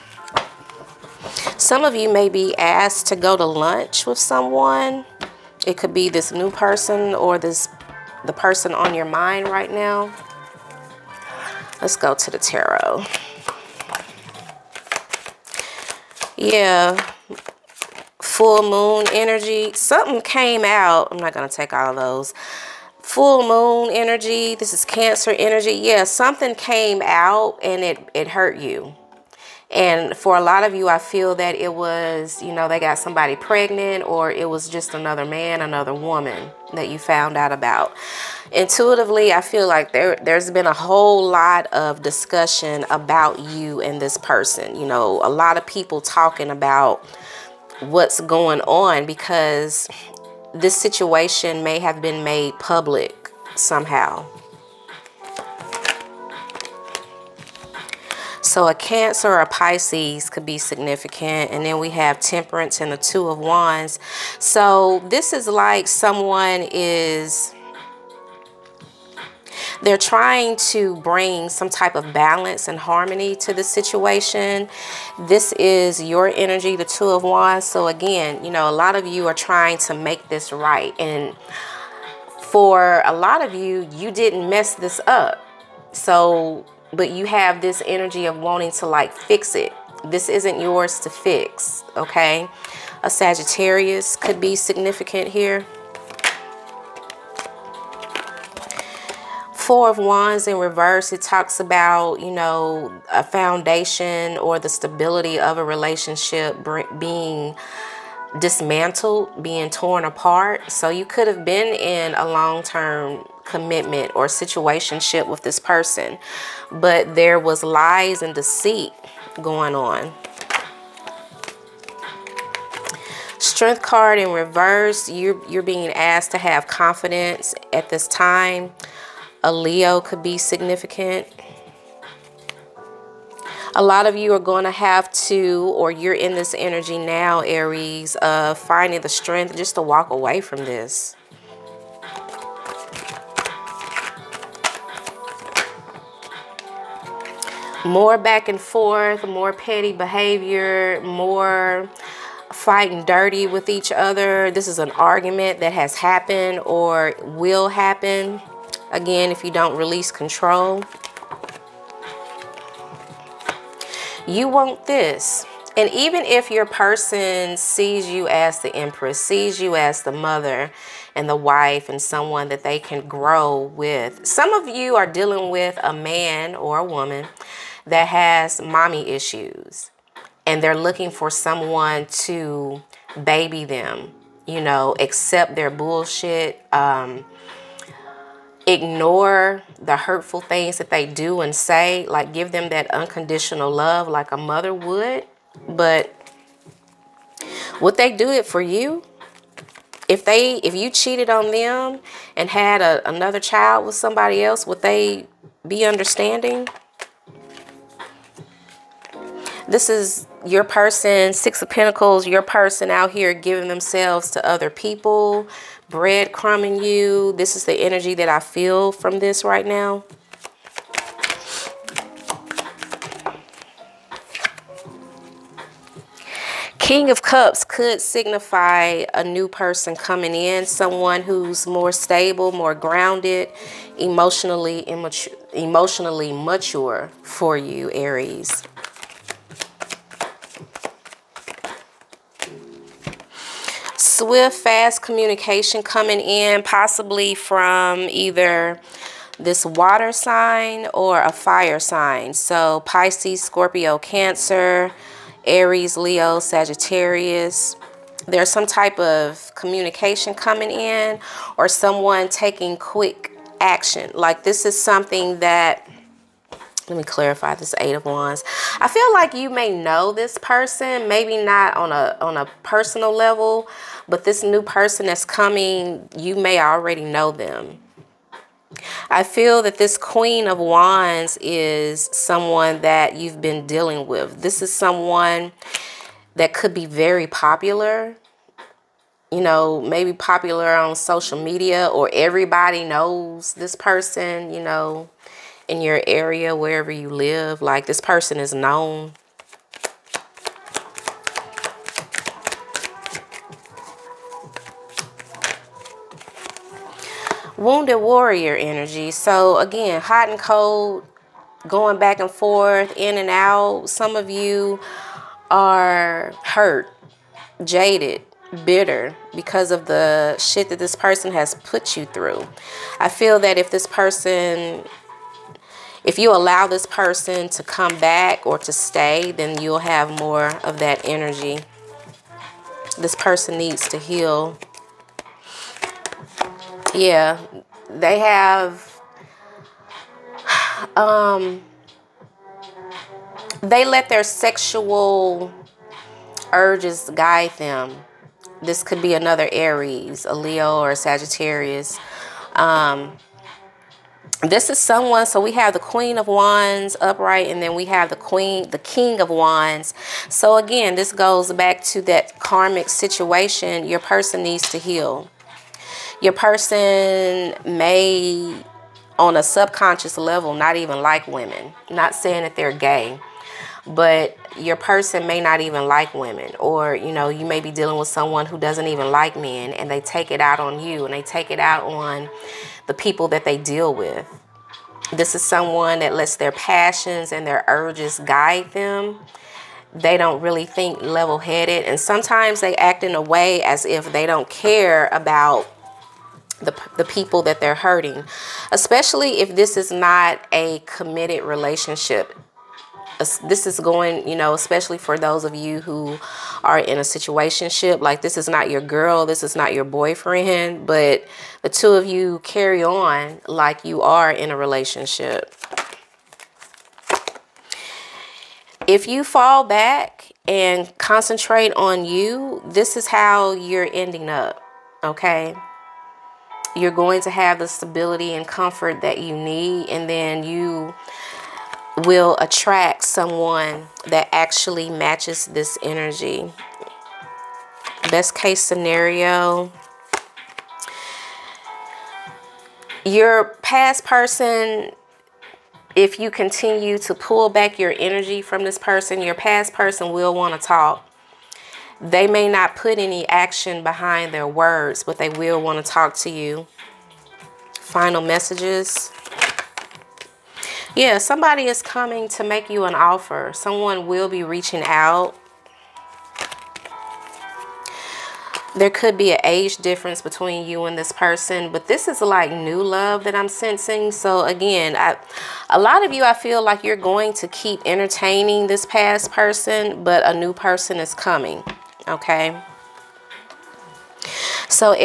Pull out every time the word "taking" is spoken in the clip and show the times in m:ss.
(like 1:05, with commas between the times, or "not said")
4:22.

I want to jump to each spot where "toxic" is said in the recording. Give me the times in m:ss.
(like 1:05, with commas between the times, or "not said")
not said.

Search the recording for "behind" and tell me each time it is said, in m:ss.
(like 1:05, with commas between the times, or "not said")
7:33.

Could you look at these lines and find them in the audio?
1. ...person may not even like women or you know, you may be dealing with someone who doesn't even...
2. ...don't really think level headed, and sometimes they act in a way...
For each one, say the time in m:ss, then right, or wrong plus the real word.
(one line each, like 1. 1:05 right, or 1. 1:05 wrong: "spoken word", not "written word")
1. 6:14 right
2. 6:30 right.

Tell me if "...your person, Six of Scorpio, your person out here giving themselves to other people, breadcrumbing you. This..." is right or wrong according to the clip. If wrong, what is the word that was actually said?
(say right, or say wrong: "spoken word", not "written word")
wrong: "Pentacles", not "Scorpio".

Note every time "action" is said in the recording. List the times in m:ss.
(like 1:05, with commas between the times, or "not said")
4:23, 7:33.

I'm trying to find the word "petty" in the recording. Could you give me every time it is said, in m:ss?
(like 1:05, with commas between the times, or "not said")
2:29.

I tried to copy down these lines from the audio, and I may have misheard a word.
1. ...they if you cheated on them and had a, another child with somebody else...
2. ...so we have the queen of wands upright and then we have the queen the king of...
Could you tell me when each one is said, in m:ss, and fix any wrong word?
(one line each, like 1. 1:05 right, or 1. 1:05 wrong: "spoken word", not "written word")
1. 3:20 right
2. 5:55 right.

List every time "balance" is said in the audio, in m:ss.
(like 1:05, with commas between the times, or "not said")
1:12.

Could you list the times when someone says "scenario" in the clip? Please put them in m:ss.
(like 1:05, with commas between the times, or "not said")
7:18.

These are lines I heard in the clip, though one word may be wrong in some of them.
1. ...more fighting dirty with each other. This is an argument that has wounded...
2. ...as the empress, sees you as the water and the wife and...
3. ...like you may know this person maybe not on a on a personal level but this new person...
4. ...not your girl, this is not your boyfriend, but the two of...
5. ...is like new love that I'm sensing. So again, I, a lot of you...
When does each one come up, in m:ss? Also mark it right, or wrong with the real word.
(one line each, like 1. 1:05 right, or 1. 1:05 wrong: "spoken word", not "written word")
1. 2:31 wrong: "happened", not "wounded"
2. 2:48 wrong: "mother", not "water"
3. 4:29 right
4. 6:48 right
5. 7:52 right.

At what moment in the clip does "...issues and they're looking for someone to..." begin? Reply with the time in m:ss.
2:59.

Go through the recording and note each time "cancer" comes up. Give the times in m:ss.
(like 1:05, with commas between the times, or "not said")
0:24, 0:58, 4:13.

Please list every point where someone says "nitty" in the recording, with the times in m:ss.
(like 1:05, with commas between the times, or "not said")
not said.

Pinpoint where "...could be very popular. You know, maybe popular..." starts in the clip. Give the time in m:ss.
4:46.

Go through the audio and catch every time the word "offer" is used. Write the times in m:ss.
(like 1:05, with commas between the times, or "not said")
7:42.